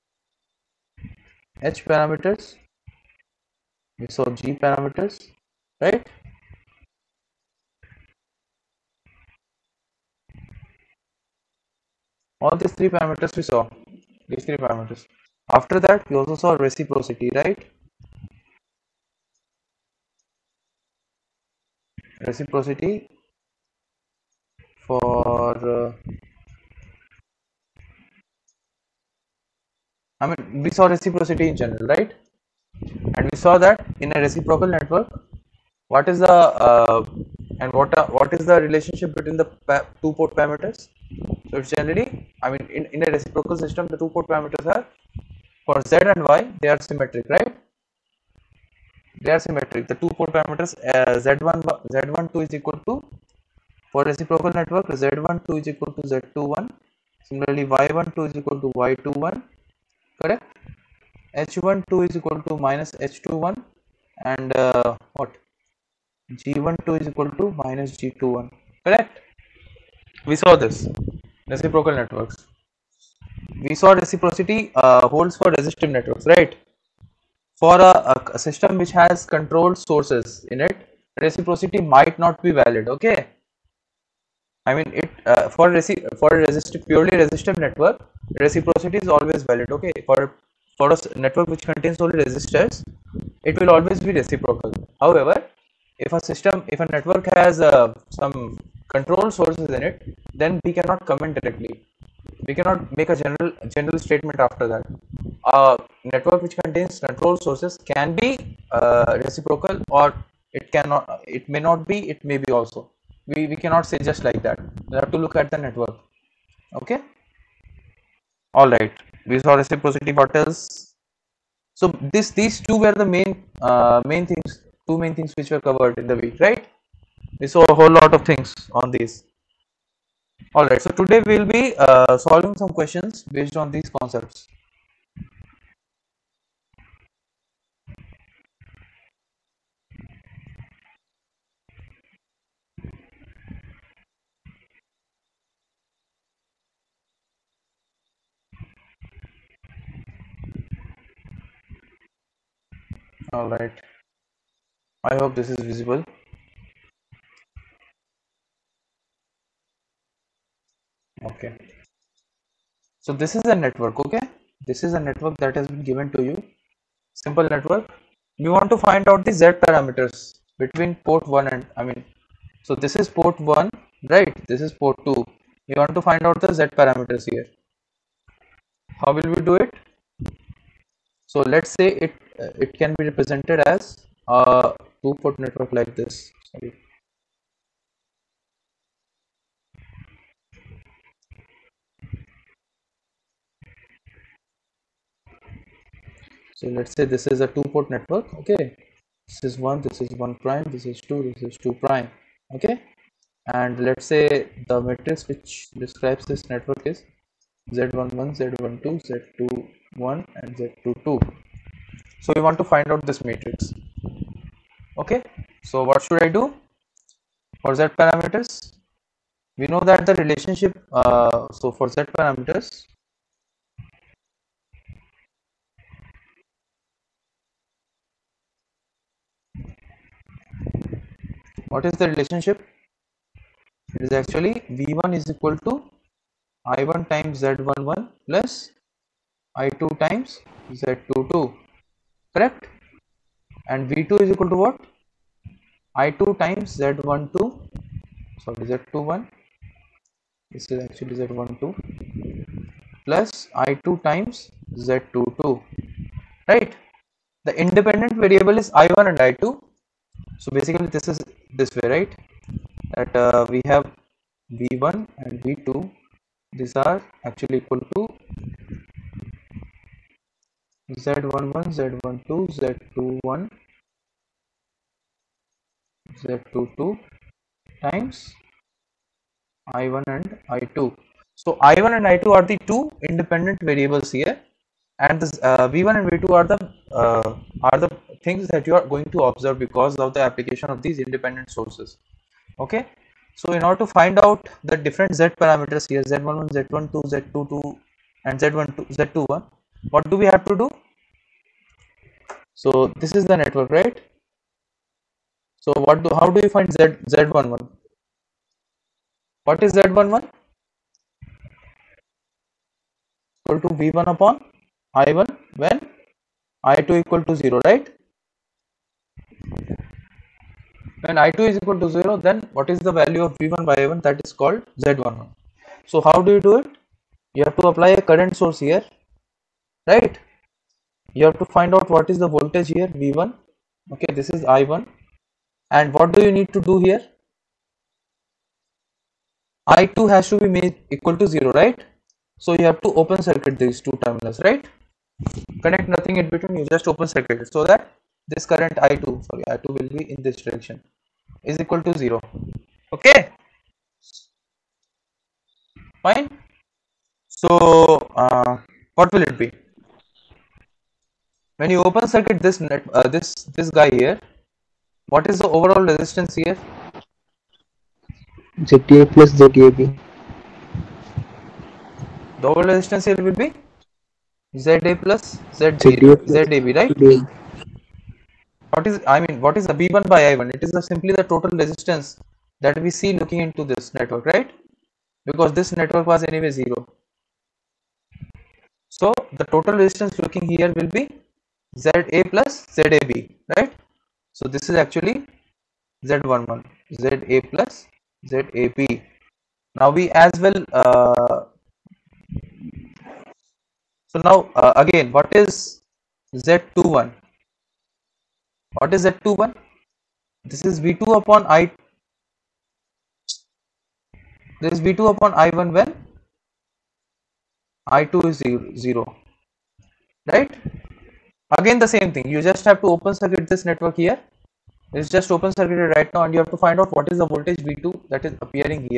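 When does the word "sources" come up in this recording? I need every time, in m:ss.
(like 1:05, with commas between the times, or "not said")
1:19, 1:39, 1:47, 4:51, 5:28.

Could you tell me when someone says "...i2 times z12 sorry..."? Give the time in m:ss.
4:06.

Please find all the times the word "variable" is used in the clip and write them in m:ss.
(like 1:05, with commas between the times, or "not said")
4:18, 4:43.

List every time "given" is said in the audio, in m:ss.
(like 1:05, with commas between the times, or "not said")
2:45.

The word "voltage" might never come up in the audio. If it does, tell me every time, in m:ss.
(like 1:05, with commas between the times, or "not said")
5:32, 7:07.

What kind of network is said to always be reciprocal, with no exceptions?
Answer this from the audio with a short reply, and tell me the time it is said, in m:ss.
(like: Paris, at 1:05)
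Purely resistive network, at 1:26.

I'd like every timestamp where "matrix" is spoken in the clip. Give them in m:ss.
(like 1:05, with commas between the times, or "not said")
3:24, 3:33.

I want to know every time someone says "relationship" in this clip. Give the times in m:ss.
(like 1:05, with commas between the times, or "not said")
0:38, 3:40, 3:52.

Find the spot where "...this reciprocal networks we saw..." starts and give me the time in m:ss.
1:10.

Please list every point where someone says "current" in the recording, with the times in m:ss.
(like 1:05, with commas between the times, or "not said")
5:28, 5:48.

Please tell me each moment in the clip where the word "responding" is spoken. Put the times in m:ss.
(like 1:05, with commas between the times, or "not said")
not said.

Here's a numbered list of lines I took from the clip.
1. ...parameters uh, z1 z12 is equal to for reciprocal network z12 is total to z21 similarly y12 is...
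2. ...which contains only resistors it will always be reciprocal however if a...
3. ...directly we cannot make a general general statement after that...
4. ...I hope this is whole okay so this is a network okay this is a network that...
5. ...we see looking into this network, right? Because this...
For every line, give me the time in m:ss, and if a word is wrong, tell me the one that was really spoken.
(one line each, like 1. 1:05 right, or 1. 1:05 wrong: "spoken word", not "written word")
1. 0:50 wrong: "equal", not "total"
2. 1:31 right
3. 1:41 right
4. 2:35 wrong: "visible", not "whole"
5. 6:22 right.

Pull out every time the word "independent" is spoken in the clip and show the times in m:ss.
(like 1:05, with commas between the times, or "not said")
4:17, 4:43, 4:50.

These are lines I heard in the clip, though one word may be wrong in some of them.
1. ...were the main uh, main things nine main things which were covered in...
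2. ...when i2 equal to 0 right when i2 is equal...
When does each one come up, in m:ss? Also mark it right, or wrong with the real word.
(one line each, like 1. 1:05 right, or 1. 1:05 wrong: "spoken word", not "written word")
1. 2:02 wrong: "two", not "nine"
2. 5:15 right.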